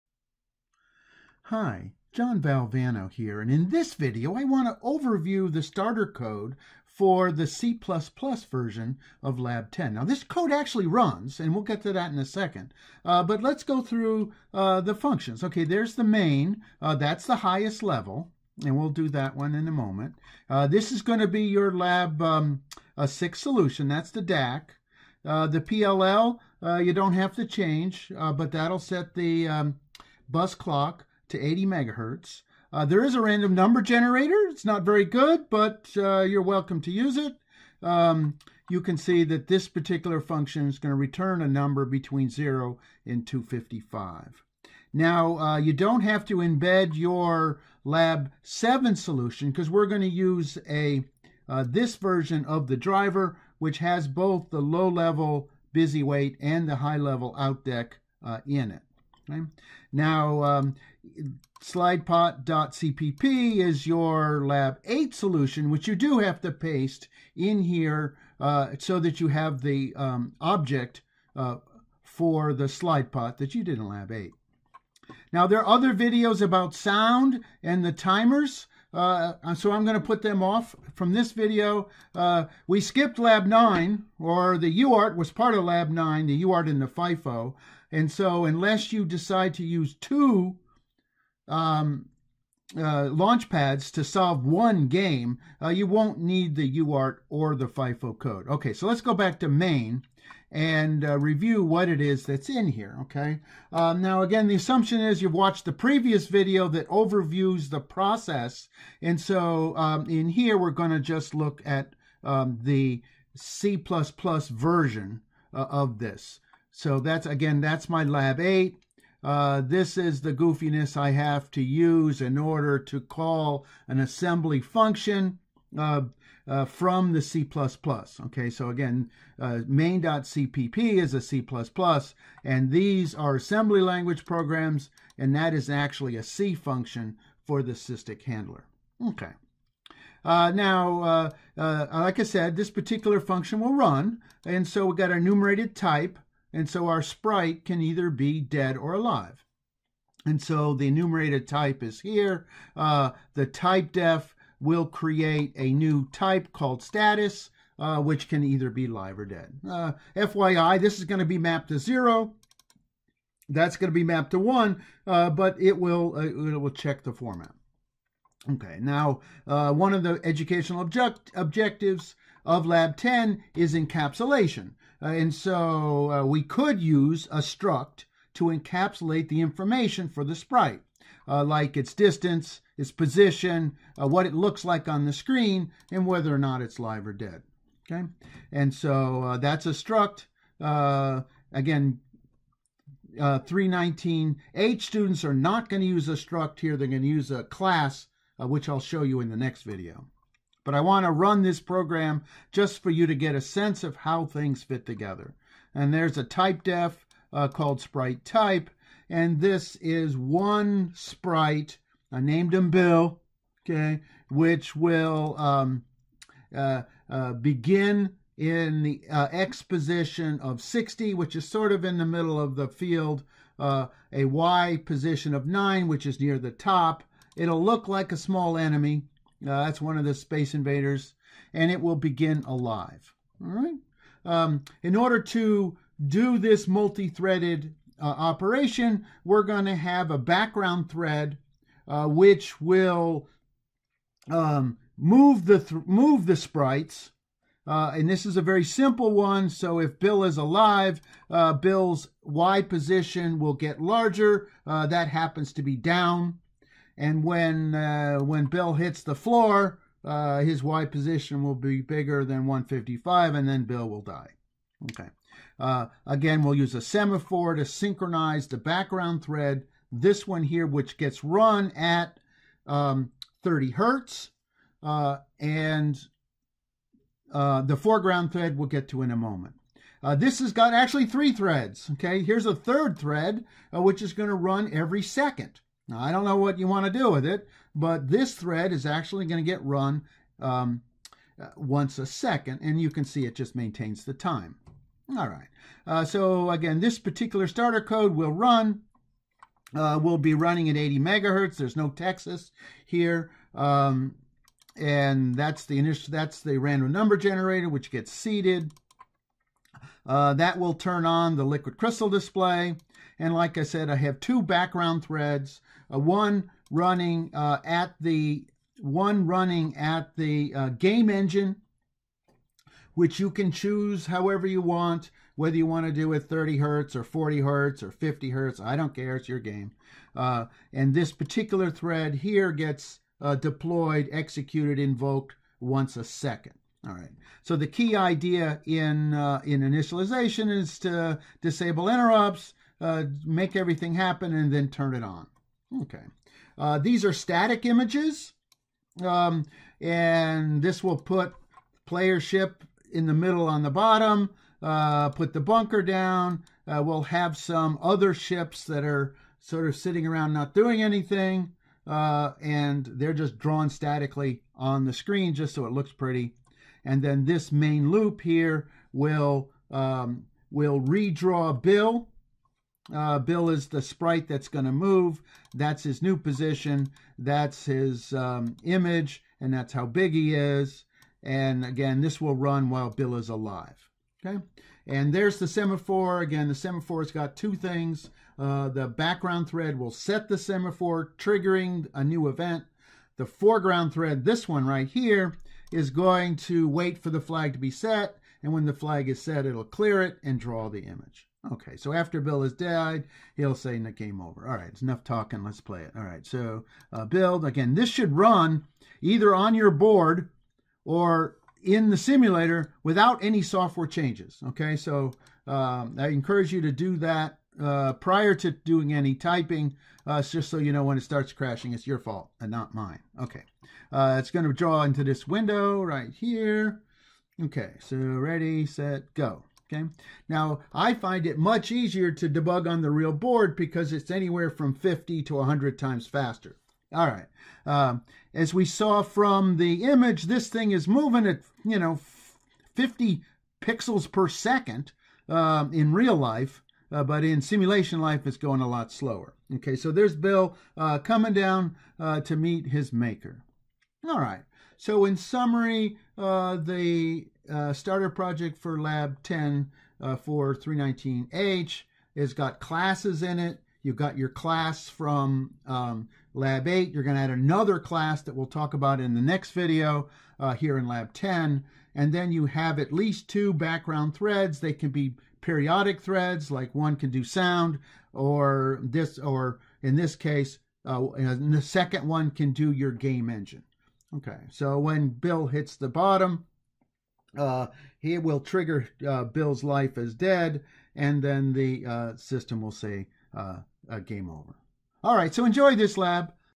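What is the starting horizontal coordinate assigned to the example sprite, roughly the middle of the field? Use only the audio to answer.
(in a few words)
60.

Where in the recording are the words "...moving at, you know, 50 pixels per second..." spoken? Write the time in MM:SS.
07:20.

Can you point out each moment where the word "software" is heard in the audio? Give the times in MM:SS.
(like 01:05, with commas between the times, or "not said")
06:53.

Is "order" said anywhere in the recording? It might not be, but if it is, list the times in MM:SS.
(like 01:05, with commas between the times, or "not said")
02:02, 03:54.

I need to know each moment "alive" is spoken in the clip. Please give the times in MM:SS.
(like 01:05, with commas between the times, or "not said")
02:28, 03:52, 04:10, 06:23.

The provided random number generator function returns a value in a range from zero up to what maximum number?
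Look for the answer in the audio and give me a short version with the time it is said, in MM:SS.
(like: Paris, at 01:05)
255, at 00:43.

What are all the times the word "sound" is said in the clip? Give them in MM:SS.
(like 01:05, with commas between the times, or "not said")
01:16, 07:57.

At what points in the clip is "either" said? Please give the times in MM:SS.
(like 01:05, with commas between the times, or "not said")
02:27, 02:38, 06:49.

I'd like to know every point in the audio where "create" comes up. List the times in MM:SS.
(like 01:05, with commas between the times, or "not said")
02:34.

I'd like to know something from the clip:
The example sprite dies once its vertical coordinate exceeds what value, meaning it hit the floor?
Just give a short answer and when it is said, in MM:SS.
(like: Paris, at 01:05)
155, at 04:22.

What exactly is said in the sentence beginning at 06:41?
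Okay, so after Bill has died, he'll say the game over.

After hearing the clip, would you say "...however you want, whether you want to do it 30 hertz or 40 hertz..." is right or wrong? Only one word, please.
right.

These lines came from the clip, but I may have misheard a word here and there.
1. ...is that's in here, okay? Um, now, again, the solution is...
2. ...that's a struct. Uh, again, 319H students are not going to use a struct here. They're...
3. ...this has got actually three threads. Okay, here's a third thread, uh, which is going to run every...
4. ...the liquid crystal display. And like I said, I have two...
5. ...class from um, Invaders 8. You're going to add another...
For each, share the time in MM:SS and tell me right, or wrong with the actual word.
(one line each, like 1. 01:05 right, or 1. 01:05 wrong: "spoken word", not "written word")
1. 01:41 wrong: "assumption", not "solution"
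2. 03:09 right
3. 04:40 right
4. 05:11 right
5. 07:44 wrong: "Lab", not "Invaders".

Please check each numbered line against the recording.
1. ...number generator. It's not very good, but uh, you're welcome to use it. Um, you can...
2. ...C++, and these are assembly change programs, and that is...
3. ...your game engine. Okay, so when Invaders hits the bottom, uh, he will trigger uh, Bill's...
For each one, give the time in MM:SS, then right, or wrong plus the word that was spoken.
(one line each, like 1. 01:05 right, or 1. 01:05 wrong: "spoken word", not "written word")
1. 00:33 right
2. 02:11 wrong: "language", not "change"
3. 08:02 wrong: "Bill", not "Invaders".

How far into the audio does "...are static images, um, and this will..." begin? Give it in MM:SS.
05:47.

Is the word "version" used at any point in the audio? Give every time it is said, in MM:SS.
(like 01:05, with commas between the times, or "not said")
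00:08, 00:51, 01:53.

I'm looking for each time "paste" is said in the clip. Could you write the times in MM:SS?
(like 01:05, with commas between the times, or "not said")
01:06.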